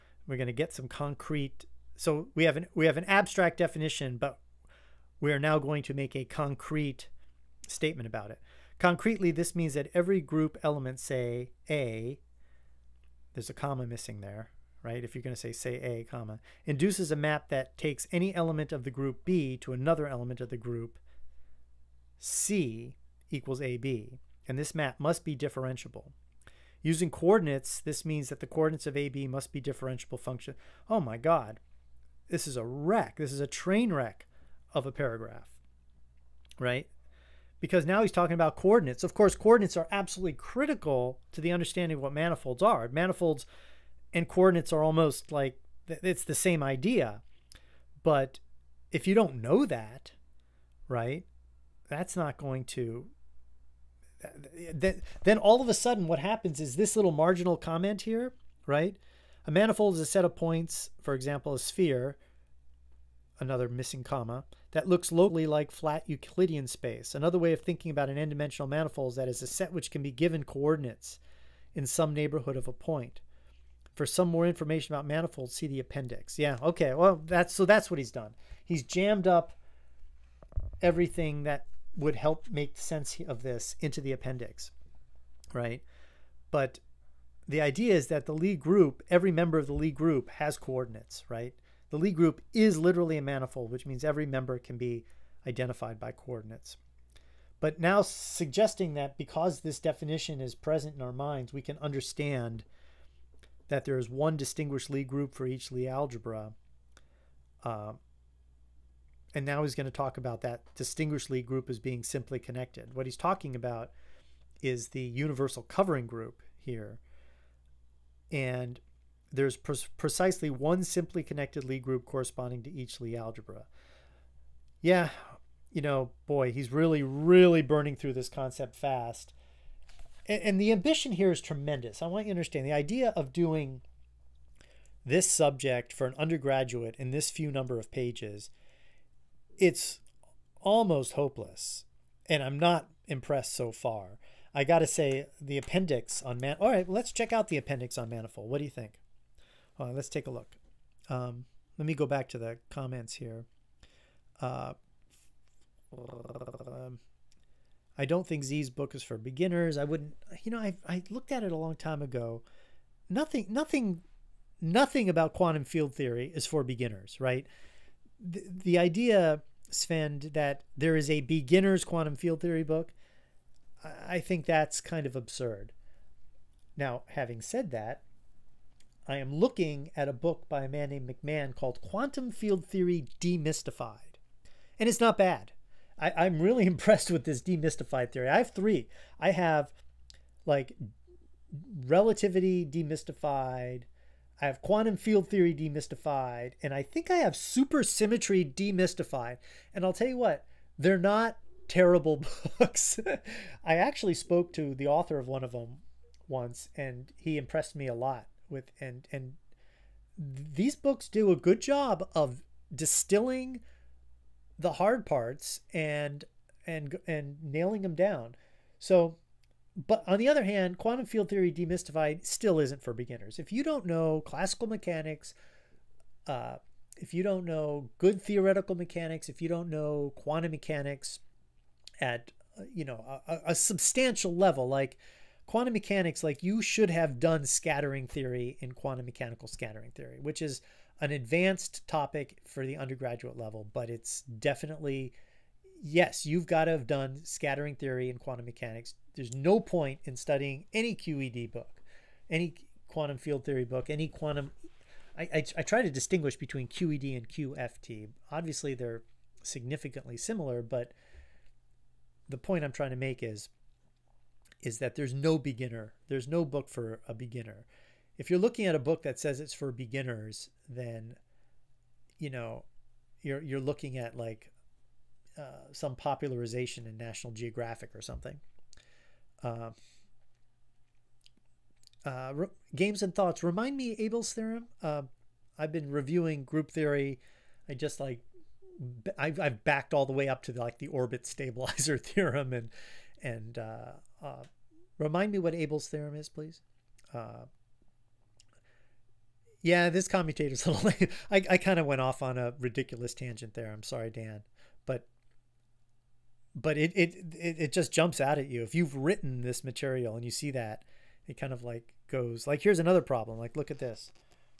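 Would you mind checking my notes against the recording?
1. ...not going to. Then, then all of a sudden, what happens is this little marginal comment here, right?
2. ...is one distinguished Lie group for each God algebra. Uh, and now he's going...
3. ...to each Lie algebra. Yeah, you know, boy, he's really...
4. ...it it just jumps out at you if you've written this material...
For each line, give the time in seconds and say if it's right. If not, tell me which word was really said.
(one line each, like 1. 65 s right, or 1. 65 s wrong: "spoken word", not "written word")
1. 52 s right
2. 103 s wrong: "Lie", not "God"
3. 122 s right
4. 307 s right.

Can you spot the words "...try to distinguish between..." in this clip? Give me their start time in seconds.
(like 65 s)
255 s.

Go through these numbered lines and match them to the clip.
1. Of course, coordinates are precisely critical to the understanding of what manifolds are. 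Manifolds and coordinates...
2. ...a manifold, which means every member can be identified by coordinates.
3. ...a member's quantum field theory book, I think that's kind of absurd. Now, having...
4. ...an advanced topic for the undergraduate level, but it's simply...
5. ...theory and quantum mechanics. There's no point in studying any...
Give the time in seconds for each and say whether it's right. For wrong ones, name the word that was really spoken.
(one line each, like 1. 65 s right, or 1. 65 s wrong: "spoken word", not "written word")
1. 39 s wrong: "absolutely", not "precisely"
2. 93 s right
3. 171 s wrong: "beginner", not "member"
4. 241 s wrong: "definitely", not "simply"
5. 247 s right.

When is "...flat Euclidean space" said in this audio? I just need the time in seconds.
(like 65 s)
65 s.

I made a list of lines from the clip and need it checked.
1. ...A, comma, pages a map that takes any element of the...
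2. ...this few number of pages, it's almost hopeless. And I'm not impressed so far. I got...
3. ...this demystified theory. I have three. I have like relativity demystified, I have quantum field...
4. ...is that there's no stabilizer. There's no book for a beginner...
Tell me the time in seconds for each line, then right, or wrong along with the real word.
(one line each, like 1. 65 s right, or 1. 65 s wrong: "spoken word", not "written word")
1. 15 s wrong: "induces", not "pages"
2. 137 s right
3. 187 s right
4. 264 s wrong: "beginner", not "stabilizer".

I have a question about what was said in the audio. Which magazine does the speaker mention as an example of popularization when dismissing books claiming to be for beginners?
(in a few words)
National Geographic.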